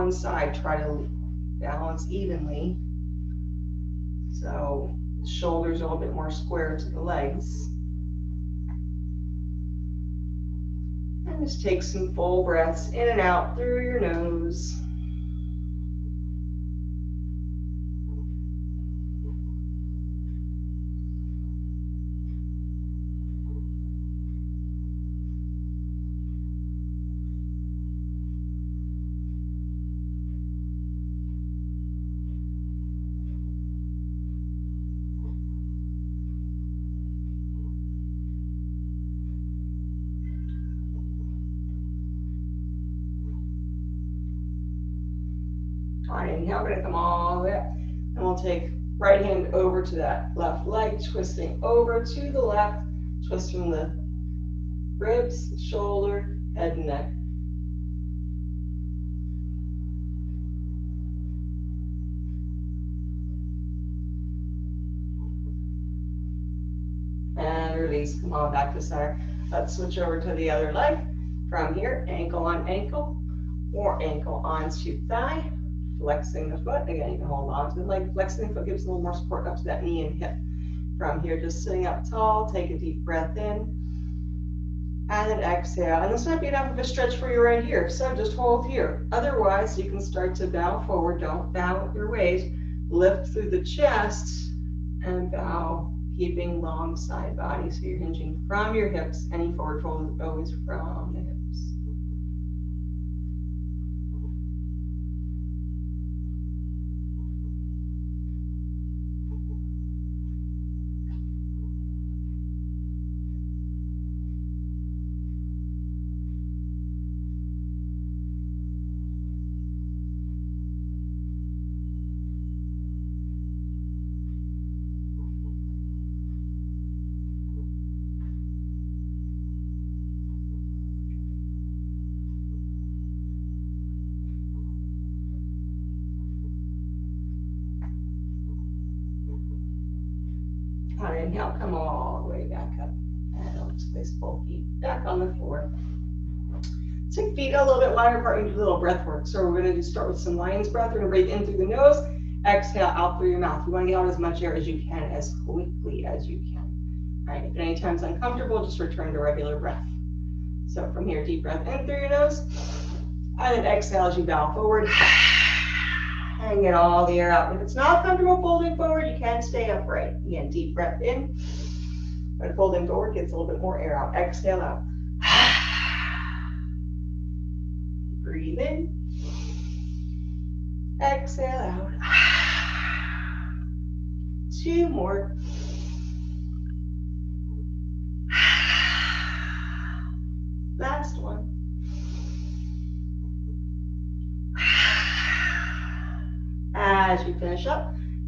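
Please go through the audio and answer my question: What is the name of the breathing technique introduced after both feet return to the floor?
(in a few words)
Lion's breath.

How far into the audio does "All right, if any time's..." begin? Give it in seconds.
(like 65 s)
157 s.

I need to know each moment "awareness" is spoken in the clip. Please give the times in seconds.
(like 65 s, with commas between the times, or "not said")
not said.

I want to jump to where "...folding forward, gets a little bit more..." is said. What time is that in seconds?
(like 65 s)
172 s.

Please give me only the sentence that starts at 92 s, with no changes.
Lift through the chest and bow, keeping long side body.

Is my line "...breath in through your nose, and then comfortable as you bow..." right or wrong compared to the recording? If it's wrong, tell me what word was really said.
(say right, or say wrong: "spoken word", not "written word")
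wrong: "exhale", not "comfortable".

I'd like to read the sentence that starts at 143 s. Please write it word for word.
And I'll just place both feet back on the floor.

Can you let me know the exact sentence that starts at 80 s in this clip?
From here, just sitting up tall, take a deep breath in and an exhale.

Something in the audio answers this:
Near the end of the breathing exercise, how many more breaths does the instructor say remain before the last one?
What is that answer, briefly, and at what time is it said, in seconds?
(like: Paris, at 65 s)
2, at 184 s.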